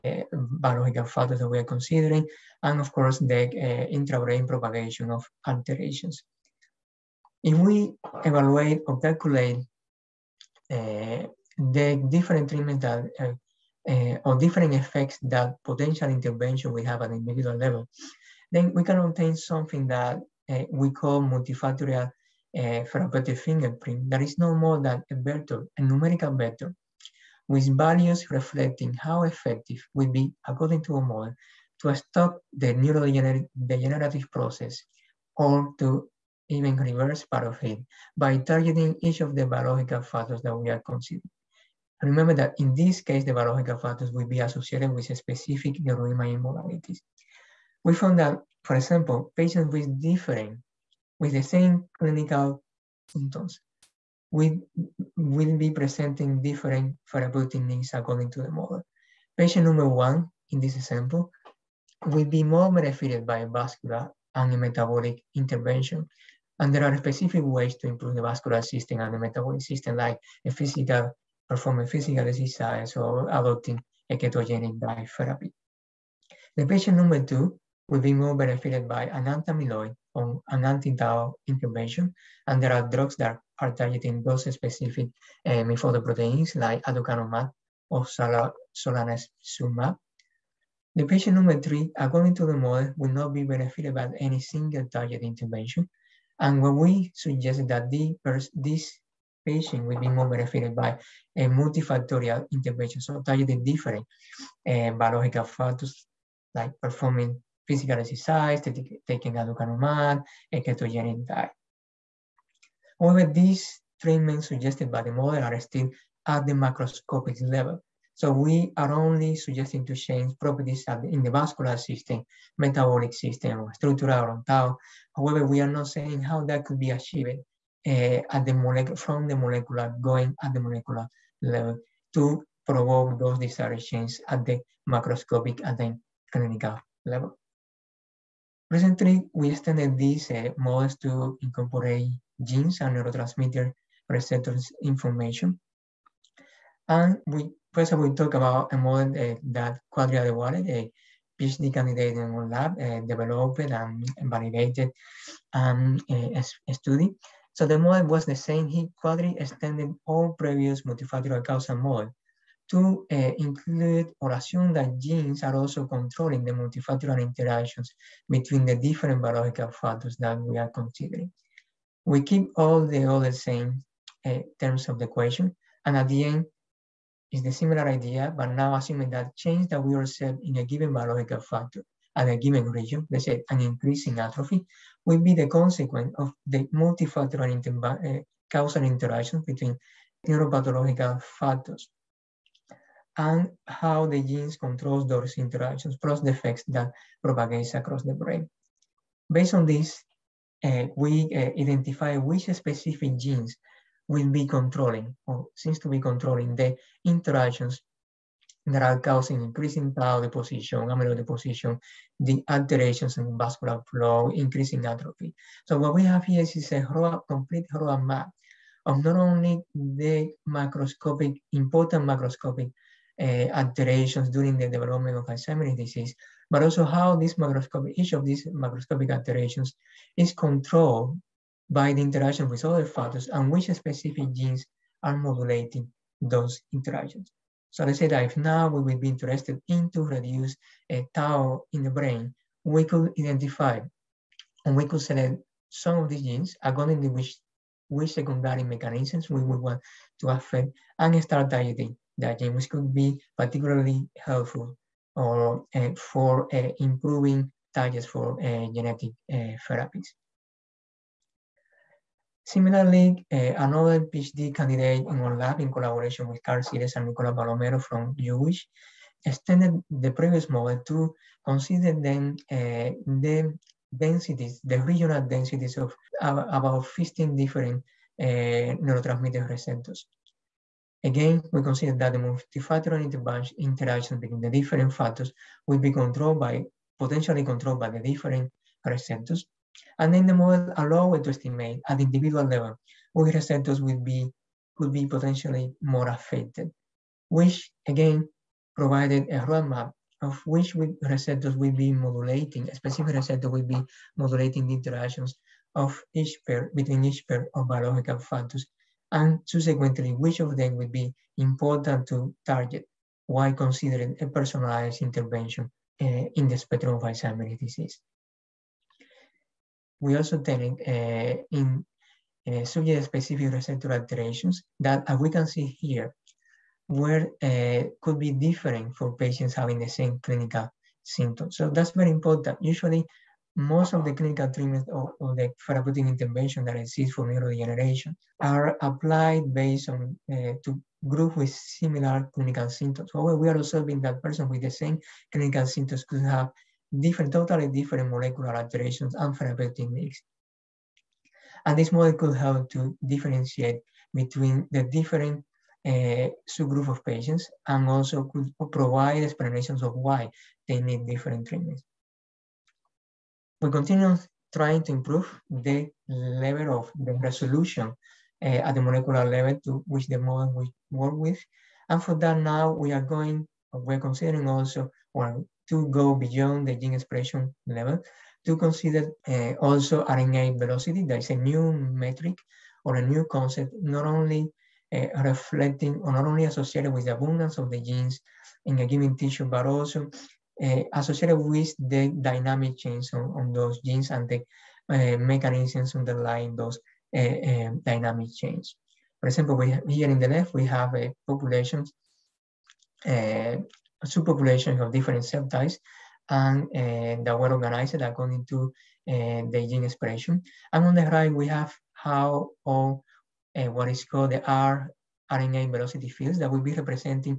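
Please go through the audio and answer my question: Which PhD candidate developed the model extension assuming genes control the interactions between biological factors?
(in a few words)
Quadri Adewale.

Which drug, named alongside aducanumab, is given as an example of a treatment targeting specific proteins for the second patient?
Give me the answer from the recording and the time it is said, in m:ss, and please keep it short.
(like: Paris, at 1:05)
solanezumab, at 1:28.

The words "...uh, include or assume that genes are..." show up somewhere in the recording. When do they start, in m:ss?
2:43.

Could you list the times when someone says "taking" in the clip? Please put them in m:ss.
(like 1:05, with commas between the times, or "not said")
1:48.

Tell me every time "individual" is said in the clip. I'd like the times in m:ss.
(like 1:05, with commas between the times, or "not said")
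0:17, 4:52.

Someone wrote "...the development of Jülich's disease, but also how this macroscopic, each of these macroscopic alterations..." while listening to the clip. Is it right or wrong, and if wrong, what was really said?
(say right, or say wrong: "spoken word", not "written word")
wrong: "Alzheimer", not "Jülich".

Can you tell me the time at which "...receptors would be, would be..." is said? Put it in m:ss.
4:53.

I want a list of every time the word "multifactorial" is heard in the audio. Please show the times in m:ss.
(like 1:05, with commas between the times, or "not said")
0:21, 1:41, 2:40, 2:46, 3:06, 4:42.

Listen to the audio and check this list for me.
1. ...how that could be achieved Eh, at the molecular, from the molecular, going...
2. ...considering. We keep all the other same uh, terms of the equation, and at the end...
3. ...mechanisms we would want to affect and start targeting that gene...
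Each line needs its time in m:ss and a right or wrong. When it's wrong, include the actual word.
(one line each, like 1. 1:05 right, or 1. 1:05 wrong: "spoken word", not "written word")
1. 2:06 right
2. 2:50 right
3. 4:08 right.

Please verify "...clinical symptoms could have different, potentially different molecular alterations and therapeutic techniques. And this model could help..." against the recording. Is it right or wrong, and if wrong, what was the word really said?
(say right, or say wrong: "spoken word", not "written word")
wrong: "totally", not "potentially".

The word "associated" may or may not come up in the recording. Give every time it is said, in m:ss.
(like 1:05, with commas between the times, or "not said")
0:44, 6:26, 6:30.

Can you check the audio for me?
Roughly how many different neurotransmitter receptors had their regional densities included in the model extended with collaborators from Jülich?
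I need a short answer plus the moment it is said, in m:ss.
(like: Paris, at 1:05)
15, at 4:36.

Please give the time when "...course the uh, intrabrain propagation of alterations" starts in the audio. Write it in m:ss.
0:02.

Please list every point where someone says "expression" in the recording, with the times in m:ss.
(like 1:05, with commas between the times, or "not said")
6:16, 6:49.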